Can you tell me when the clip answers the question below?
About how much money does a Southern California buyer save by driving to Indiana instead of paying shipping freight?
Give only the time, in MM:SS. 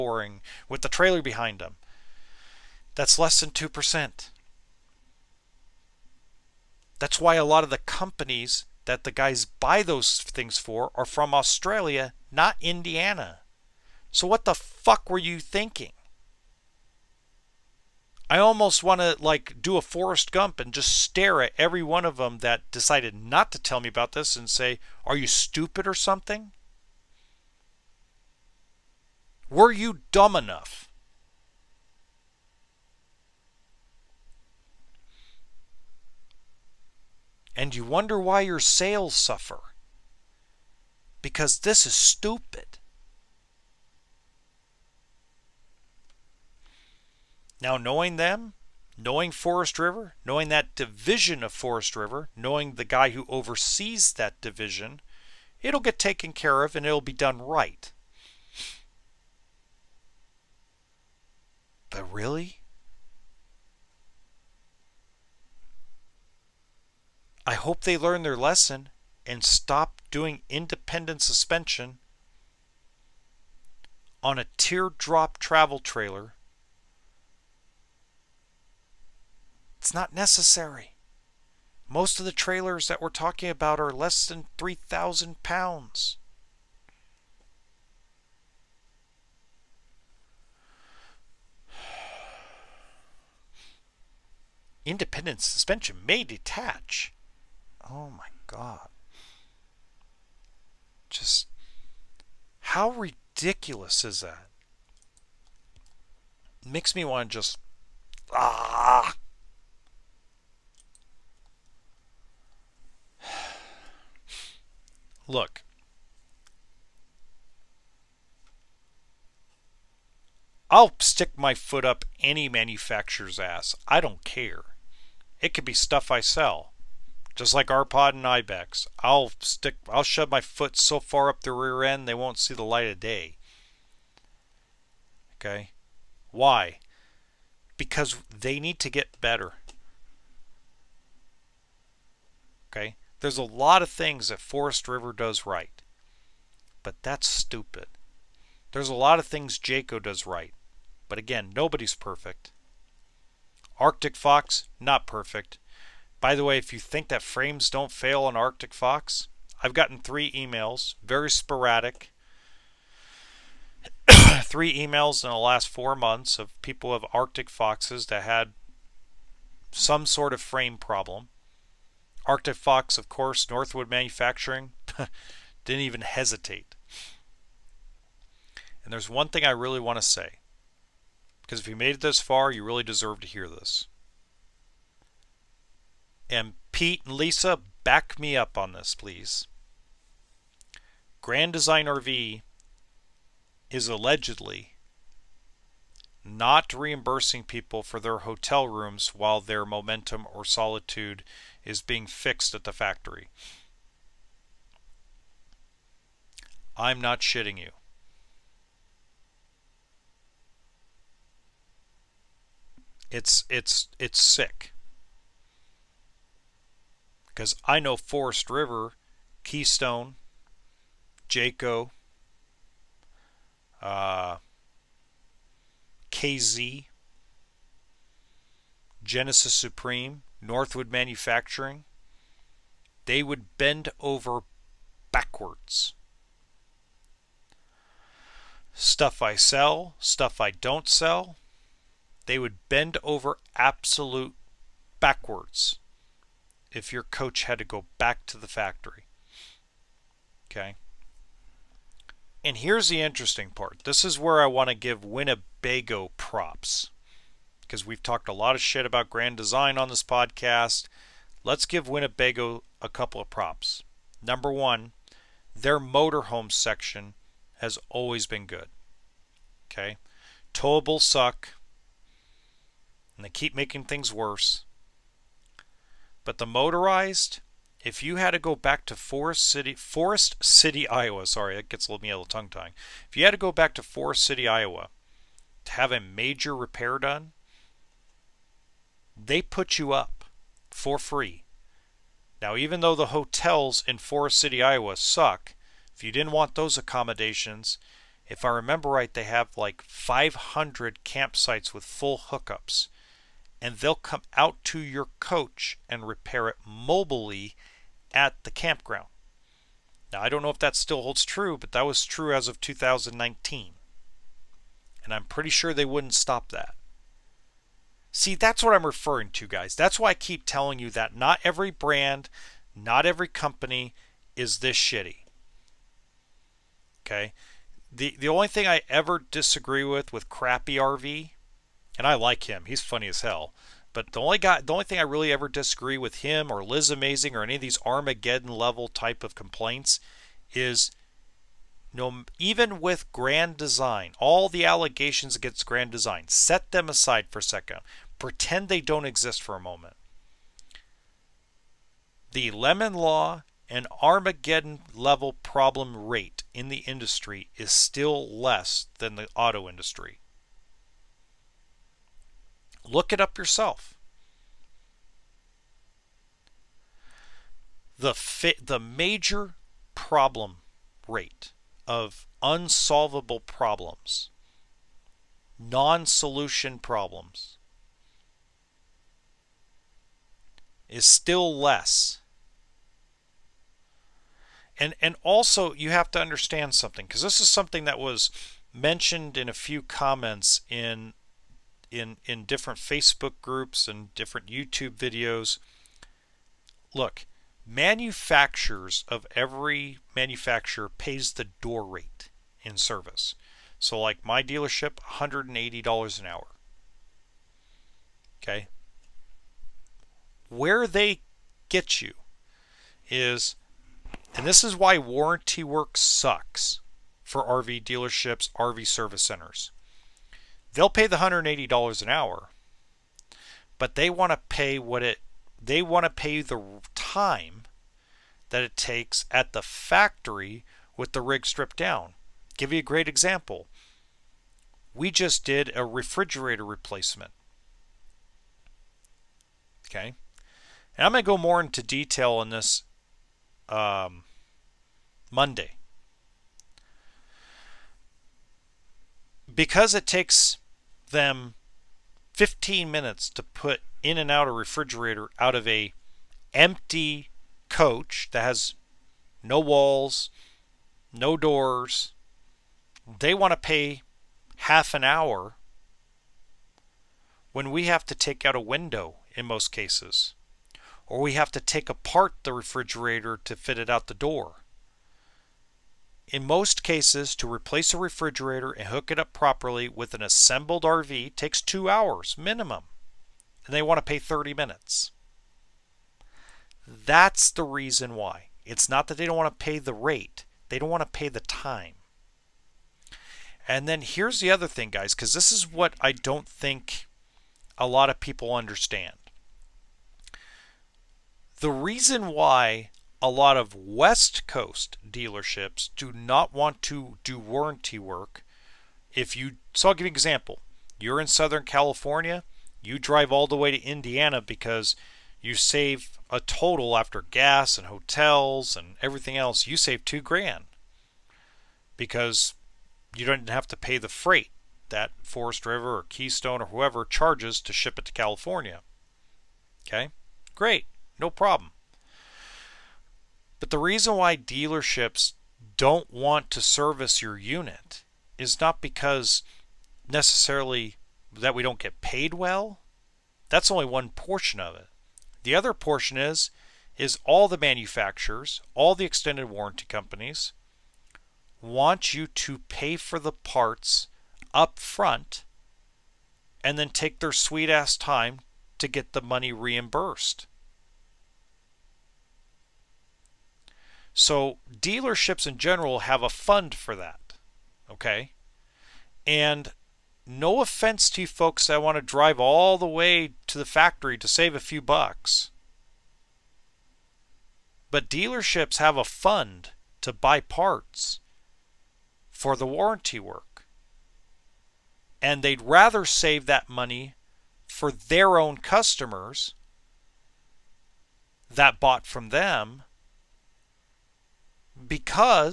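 08:40.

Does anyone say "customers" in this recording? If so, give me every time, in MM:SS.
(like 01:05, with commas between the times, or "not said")
09:48.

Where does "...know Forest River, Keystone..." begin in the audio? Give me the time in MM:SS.
03:37.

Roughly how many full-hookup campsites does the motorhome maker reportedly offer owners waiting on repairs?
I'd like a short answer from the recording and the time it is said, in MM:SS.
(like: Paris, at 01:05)
500, at 04:59.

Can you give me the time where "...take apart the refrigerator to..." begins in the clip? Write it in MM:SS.
07:51.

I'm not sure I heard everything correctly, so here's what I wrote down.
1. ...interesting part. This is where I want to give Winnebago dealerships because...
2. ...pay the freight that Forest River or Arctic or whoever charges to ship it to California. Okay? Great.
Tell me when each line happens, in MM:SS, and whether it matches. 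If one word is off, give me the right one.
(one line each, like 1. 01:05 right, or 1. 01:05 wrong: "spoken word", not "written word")
1. 04:12 wrong: "props", not "dealerships"
2. 08:43 wrong: "Keystone", not "Arctic".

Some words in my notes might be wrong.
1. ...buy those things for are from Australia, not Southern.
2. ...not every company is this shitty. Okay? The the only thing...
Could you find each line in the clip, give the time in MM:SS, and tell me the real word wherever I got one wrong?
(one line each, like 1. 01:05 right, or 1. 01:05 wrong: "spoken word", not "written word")
1. 00:09 wrong: "Indiana", not "Southern"
2. 05:22 right.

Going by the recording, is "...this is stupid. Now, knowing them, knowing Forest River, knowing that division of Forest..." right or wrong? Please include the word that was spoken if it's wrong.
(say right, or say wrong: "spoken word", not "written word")
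right.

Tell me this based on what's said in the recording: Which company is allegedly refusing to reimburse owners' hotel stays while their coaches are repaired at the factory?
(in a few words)
Grand Design RV.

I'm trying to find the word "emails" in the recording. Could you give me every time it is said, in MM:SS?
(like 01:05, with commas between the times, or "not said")
02:40, 02:44.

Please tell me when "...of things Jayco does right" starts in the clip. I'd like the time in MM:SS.
02:29.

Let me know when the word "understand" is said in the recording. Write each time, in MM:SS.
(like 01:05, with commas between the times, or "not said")
06:26, 08:18.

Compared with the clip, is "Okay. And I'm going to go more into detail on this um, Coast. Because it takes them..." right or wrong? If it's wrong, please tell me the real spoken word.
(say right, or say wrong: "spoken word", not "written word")
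wrong: "Monday", not "Coast".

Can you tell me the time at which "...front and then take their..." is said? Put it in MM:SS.
09:14.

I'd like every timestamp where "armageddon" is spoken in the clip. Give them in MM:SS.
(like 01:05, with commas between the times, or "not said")
05:37, 05:54.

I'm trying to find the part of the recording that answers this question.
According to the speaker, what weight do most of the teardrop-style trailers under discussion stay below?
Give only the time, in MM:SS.
01:24.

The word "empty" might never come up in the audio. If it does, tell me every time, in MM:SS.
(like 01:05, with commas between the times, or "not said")
07:36.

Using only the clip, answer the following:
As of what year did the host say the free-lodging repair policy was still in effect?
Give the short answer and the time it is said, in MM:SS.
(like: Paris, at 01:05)
2019, at 05:12.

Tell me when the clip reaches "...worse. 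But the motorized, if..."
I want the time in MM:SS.
04:34.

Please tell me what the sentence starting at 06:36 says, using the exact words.
Look, manufacturers of every manufacturer pays the door rate in service.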